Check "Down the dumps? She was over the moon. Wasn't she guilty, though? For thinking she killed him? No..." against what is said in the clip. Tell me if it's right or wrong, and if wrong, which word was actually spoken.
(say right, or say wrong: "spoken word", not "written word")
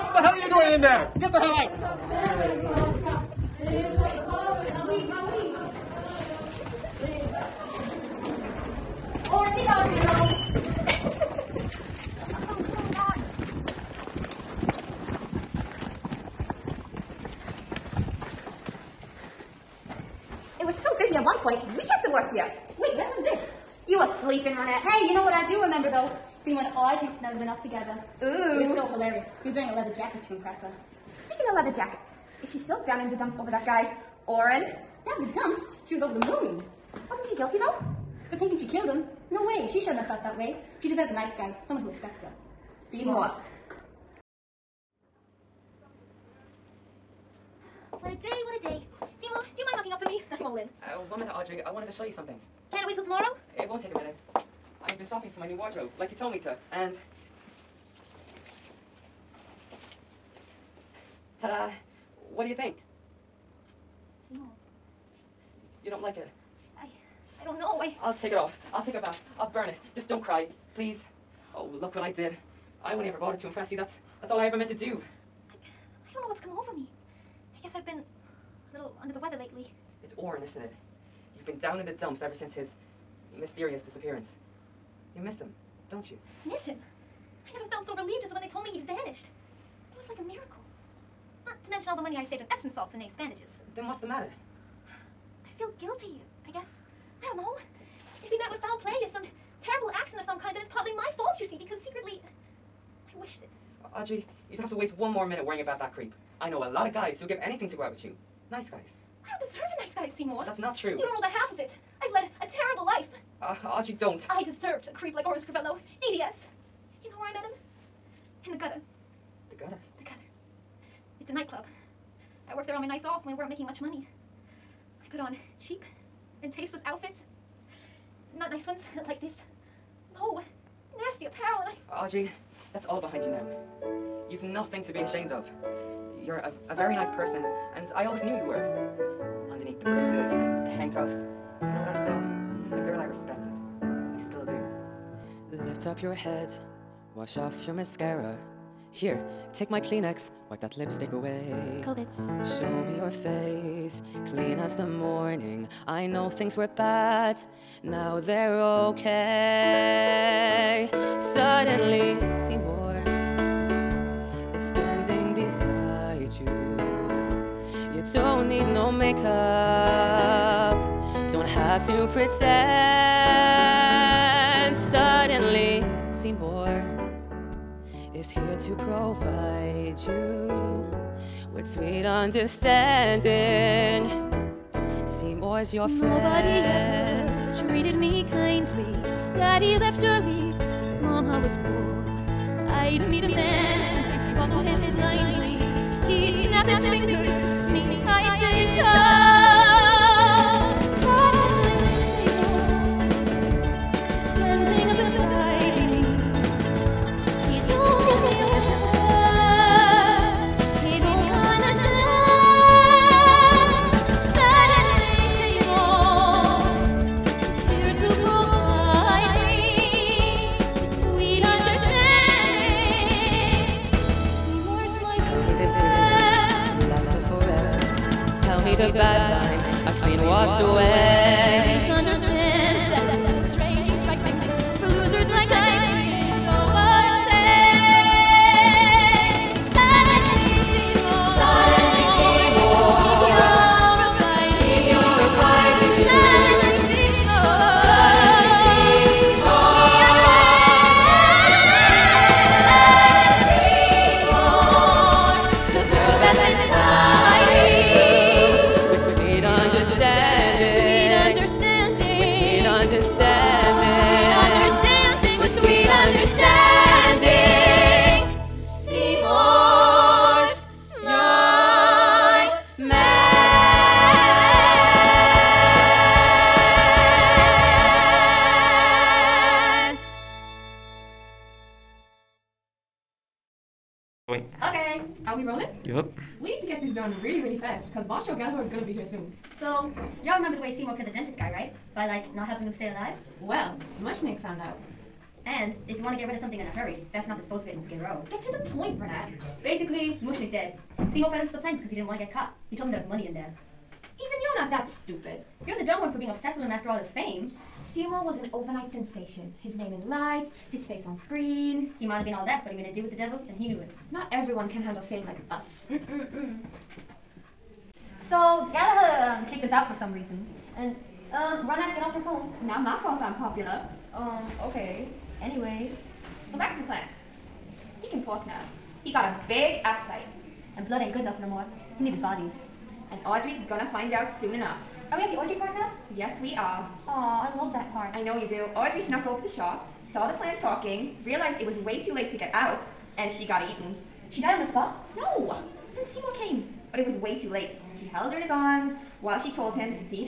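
right.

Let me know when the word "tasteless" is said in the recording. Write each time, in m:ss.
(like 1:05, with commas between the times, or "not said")
2:06.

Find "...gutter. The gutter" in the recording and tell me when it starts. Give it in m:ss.
1:58.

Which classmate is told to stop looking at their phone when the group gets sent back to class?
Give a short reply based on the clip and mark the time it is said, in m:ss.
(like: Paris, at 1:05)
Ronald, at 5:21.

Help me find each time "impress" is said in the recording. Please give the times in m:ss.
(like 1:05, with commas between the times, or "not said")
0:30, 1:13.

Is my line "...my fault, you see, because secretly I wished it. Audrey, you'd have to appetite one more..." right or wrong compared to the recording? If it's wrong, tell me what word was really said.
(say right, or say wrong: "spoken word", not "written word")
wrong: "waste", not "appetite".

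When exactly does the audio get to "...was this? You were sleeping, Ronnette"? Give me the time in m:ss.
0:23.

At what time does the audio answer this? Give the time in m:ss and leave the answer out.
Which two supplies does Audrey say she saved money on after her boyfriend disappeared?
1:32.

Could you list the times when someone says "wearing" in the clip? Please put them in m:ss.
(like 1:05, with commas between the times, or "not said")
0:29.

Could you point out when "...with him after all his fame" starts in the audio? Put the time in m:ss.
5:06.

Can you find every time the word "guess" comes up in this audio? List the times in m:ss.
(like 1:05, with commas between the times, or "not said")
1:17, 1:36.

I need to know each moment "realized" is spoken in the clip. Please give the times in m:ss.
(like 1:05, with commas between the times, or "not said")
5:41.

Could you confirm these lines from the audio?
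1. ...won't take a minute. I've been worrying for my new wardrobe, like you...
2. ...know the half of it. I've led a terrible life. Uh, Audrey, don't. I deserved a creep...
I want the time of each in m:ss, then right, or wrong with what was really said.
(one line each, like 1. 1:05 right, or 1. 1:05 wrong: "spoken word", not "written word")
1. 0:53 wrong: "shopping", not "worrying"
2. 1:51 right.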